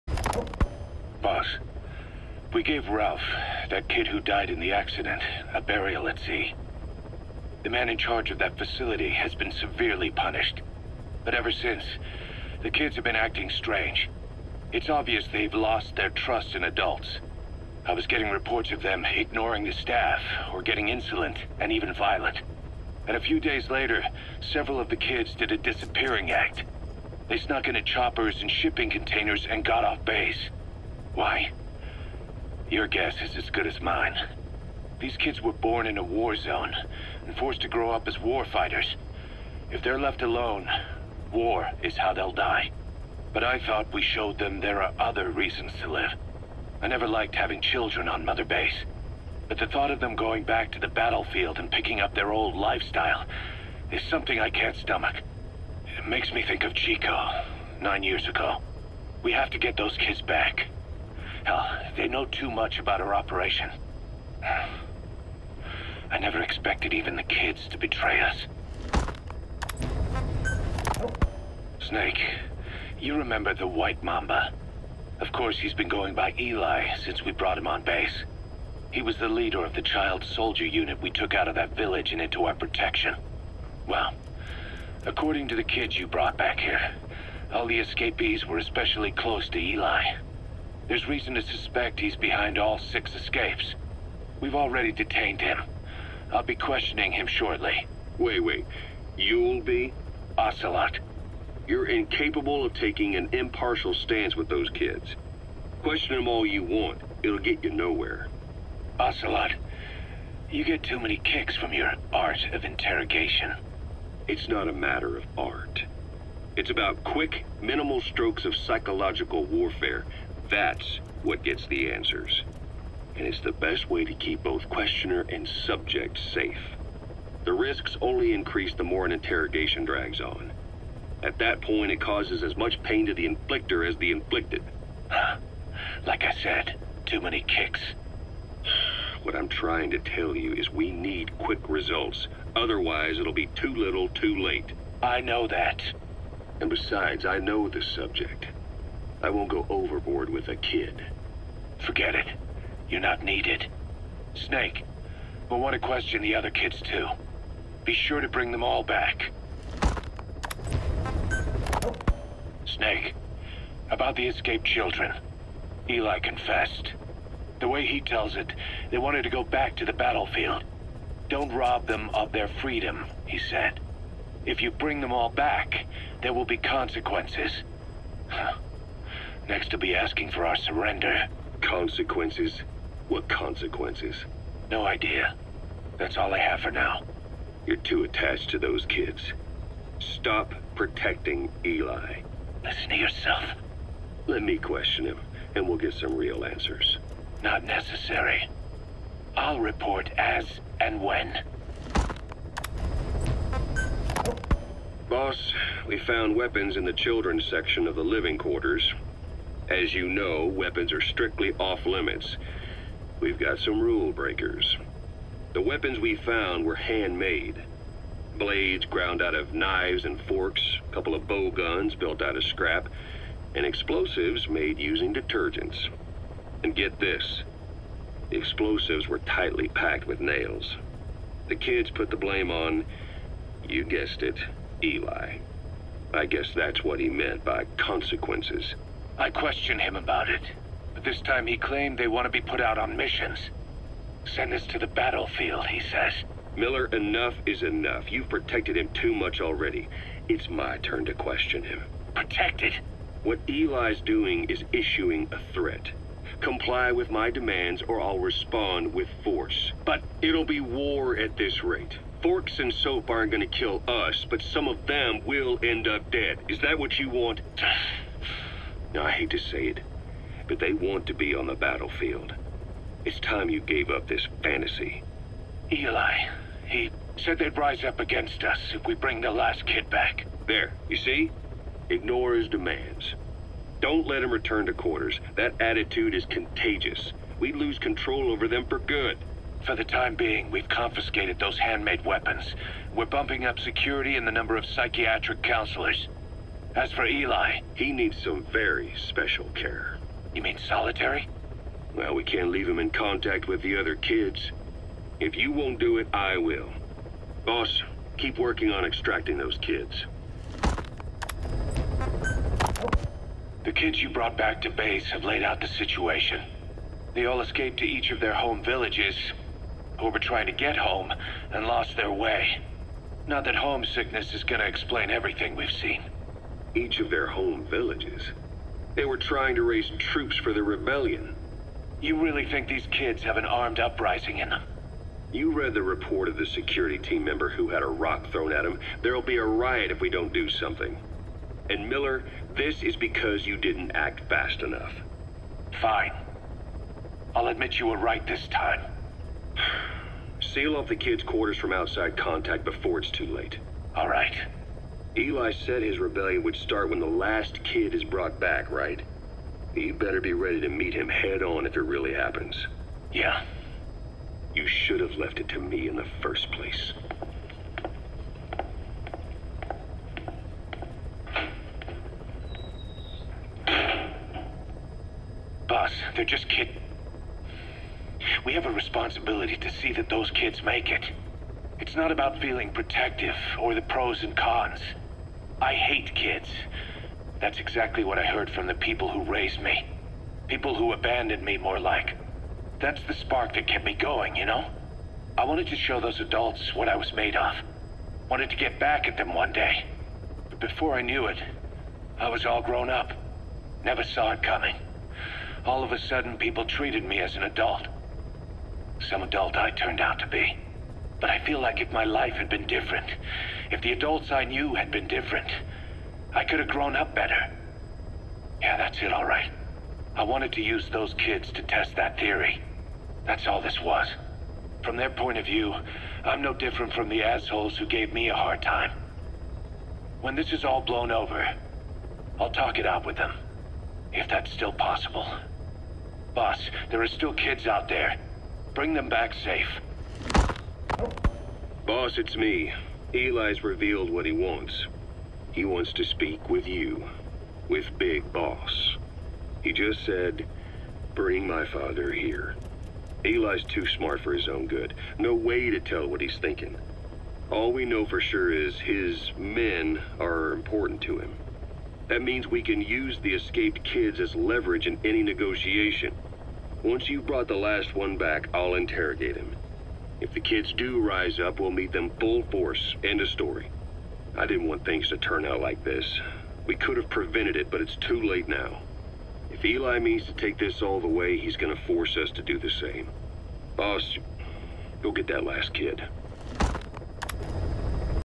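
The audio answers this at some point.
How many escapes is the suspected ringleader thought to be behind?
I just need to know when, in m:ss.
1:32.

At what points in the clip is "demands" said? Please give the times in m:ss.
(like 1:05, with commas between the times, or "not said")
4:17, 4:42.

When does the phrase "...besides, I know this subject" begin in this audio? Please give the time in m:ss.
2:26.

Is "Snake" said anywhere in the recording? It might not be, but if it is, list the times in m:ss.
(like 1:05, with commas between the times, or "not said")
1:11, 2:34, 2:42.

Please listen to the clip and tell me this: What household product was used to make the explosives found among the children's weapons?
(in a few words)
Detergents.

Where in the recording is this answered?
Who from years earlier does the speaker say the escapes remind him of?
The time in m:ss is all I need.
0:56.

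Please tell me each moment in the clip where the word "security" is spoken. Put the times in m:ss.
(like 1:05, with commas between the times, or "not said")
4:53, 5:36.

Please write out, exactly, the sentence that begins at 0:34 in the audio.
These kids were born in a war zone and forced to grow up as war fighters.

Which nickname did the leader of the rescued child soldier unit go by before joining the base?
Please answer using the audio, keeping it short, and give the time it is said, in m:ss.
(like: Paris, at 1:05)
White Mamba, at 1:13.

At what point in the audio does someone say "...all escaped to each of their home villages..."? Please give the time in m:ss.
5:17.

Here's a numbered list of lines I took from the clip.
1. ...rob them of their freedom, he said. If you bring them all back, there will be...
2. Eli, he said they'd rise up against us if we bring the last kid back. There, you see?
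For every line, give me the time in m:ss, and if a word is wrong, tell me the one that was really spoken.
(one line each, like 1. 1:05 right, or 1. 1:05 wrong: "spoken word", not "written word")
1. 2:51 right
2. 4:35 right.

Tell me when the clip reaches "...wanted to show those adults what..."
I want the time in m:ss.
6:35.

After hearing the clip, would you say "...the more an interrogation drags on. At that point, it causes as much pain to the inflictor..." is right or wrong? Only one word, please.
right.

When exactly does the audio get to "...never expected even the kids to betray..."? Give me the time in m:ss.
1:06.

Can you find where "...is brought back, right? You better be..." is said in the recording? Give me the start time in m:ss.
5:57.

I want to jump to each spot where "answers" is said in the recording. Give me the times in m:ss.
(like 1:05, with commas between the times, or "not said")
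2:01, 3:16.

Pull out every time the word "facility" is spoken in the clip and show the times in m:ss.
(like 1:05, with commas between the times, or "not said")
0:08.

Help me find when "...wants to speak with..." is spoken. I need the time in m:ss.
7:25.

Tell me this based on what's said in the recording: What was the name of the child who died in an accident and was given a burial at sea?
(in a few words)
Ralph.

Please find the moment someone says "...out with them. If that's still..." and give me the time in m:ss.
7:12.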